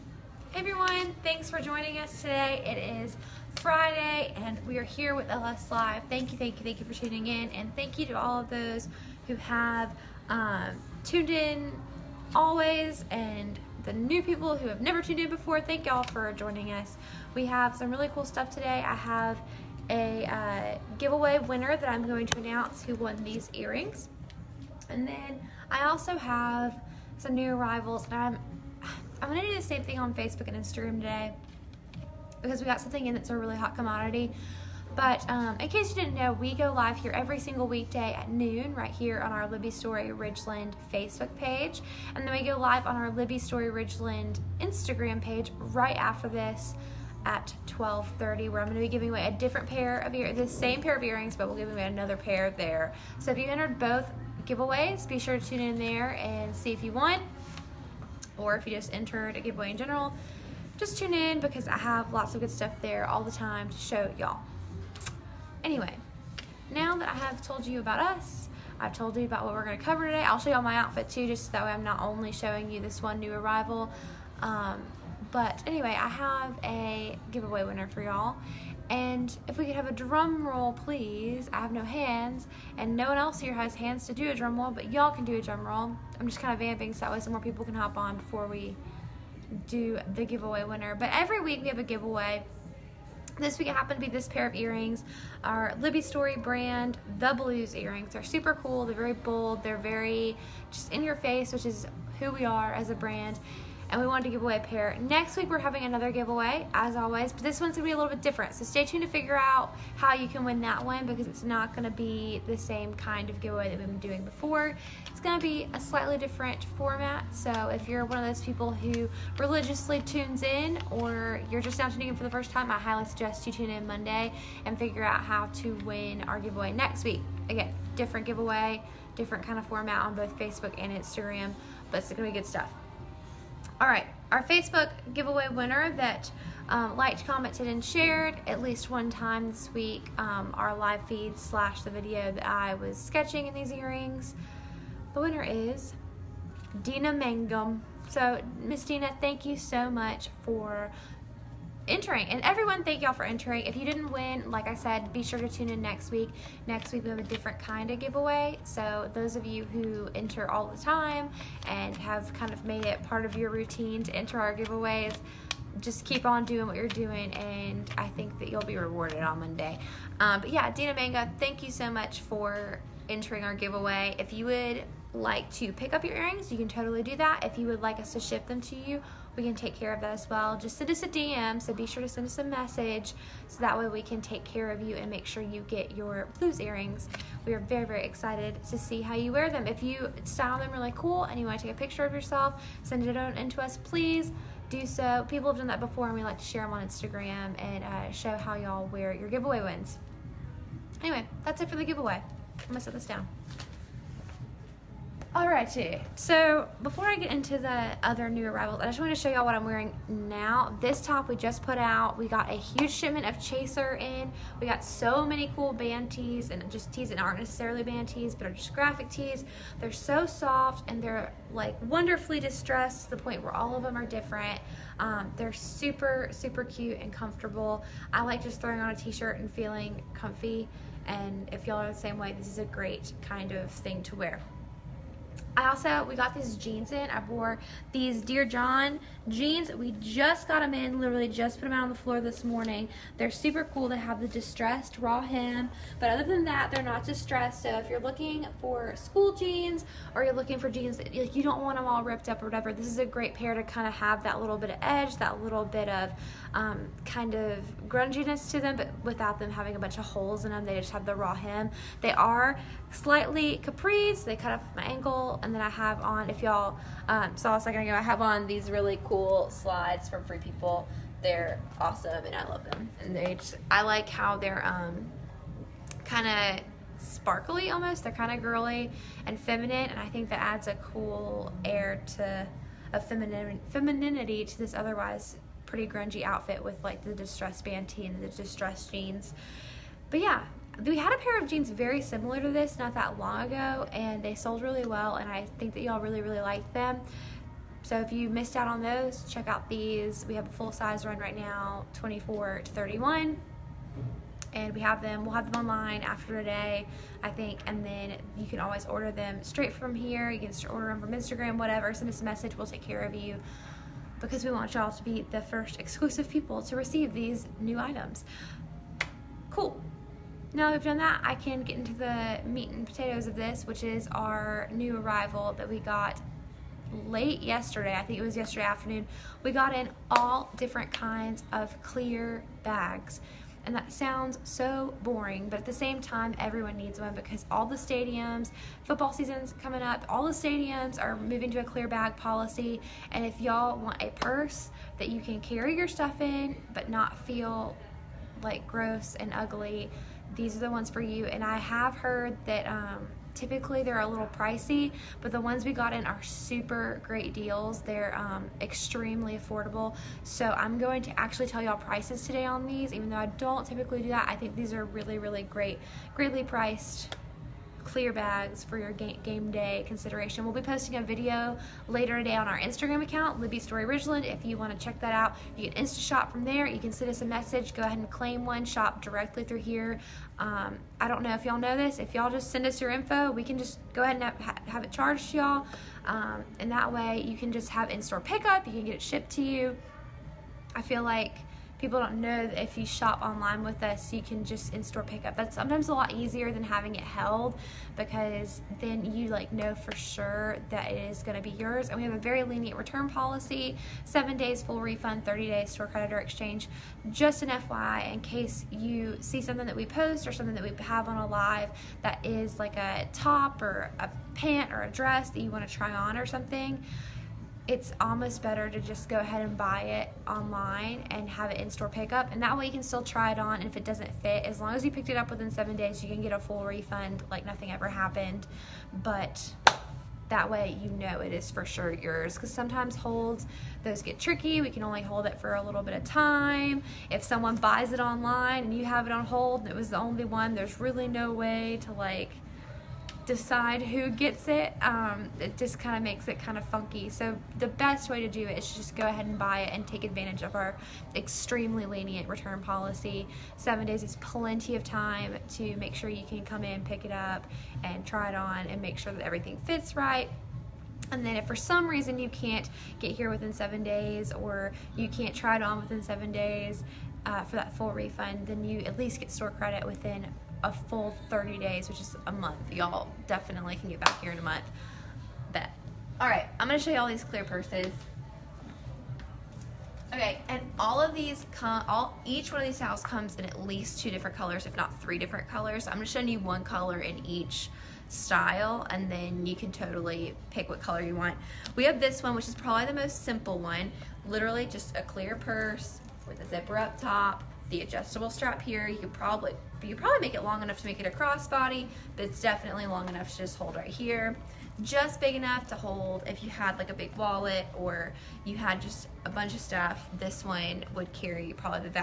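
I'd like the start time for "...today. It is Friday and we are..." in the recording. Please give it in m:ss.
0:02.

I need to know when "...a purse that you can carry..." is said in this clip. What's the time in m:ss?
5:43.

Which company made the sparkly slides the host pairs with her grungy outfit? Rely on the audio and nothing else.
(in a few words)
Free People.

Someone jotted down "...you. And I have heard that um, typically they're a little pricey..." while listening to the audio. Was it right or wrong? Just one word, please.
right.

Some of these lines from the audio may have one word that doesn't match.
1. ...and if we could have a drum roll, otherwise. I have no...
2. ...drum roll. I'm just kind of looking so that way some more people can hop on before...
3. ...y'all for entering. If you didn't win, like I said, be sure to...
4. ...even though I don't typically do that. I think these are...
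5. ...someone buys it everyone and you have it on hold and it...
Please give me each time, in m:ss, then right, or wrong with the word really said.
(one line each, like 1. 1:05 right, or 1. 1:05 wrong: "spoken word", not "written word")
1. 1:18 wrong: "please", not "otherwise"
2. 1:25 wrong: "vamping", not "looking"
3. 2:33 right
4. 6:02 right
5. 7:17 wrong: "online", not "everyone".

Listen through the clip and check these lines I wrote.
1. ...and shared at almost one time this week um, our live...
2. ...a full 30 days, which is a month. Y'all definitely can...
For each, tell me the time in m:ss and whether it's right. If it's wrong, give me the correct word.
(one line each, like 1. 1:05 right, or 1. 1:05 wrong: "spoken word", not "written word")
1. 2:17 wrong: "least", not "almost"
2. 7:50 right.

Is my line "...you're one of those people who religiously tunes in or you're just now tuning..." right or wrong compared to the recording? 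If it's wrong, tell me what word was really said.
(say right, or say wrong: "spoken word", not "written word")
right.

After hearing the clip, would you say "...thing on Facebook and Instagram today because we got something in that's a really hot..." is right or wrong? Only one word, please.
right.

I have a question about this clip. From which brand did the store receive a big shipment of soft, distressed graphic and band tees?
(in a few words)
Chaser.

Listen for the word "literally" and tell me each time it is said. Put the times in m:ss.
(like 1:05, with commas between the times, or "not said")
4:00, 8:14.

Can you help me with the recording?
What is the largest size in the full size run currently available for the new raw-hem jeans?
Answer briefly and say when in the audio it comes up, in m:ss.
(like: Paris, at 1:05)
31, at 5:02.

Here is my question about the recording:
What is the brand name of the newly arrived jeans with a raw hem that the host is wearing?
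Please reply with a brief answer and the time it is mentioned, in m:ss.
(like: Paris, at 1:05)
Dear John, at 3:58.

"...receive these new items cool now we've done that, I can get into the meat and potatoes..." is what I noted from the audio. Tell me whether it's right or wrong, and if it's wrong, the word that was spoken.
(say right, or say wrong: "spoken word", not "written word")
right.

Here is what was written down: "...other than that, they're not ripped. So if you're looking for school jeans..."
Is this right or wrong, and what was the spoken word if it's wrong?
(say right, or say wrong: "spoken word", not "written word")
wrong: "distressed", not "ripped".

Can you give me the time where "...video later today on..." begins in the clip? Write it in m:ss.
6:11.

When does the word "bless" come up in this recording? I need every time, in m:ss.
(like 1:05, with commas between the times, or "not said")
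not said.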